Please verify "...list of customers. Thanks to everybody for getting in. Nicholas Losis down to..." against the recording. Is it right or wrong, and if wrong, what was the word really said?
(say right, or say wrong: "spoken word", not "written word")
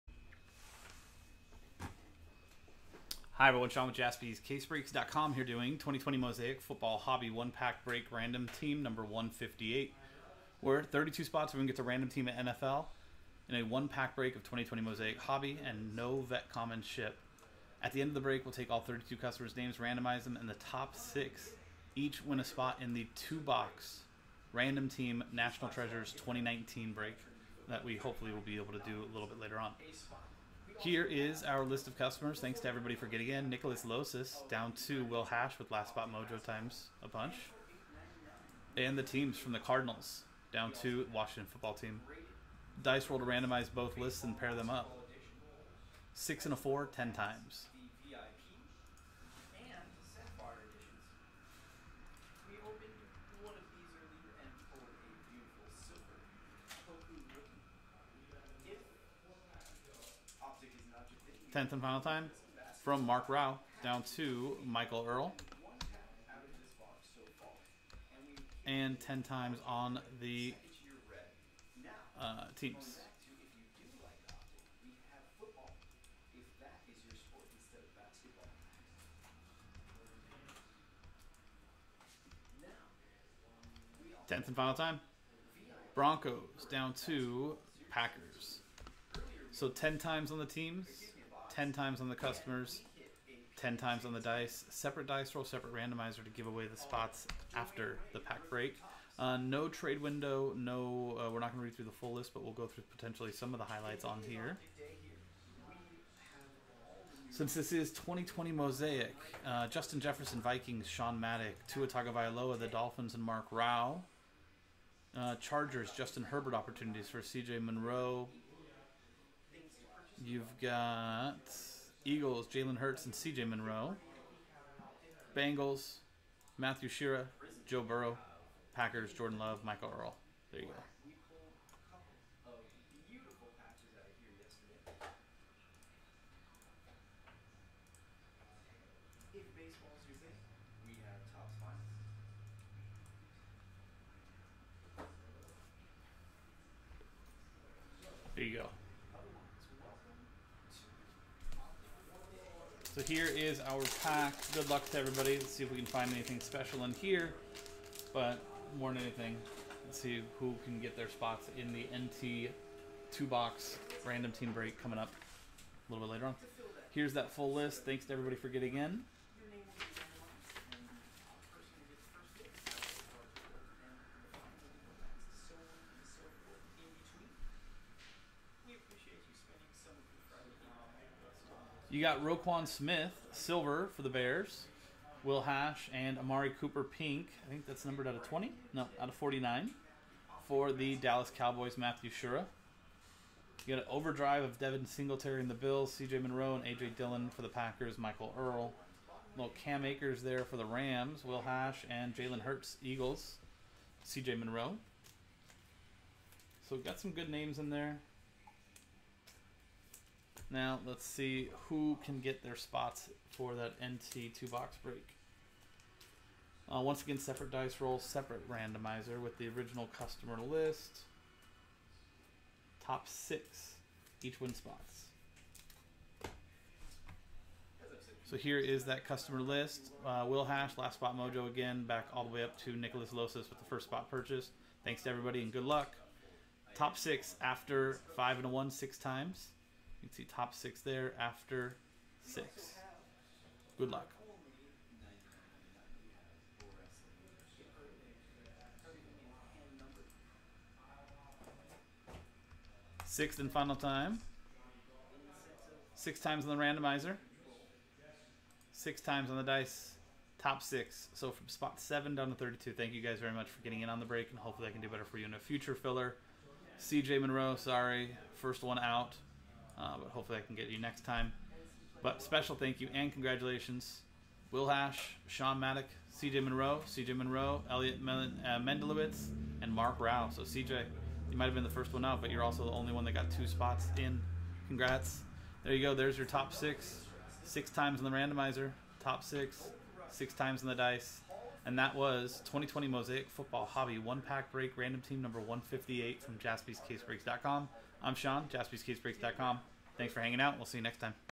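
right.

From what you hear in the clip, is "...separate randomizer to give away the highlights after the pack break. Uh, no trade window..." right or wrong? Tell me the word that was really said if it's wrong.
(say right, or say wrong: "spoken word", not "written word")
wrong: "spots", not "highlights".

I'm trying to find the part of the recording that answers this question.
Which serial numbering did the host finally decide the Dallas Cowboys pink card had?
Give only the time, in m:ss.
3:09.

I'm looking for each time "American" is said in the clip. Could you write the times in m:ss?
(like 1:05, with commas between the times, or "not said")
not said.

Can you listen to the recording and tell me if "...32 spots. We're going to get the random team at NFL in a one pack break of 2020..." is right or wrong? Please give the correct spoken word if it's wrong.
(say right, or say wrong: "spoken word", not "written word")
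right.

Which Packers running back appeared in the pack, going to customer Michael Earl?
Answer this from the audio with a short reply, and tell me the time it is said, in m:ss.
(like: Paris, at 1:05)
AJ Dillon, at 3:16.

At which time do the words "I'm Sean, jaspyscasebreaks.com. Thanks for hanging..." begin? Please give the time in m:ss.
4:58.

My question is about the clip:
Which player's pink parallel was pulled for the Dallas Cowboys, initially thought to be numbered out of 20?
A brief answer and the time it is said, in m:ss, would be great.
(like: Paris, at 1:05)
Amari Cooper, at 3:06.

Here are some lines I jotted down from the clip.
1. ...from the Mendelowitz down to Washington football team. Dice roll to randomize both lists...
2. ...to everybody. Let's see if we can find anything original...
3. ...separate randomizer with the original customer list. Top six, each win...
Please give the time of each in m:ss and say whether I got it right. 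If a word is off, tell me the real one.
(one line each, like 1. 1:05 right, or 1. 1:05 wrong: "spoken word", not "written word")
1. 0:39 wrong: "Cardinals", not "Mendelowitz"
2. 2:34 wrong: "special", not "original"
3. 3:37 right.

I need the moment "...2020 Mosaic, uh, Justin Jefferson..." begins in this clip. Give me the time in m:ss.
1:47.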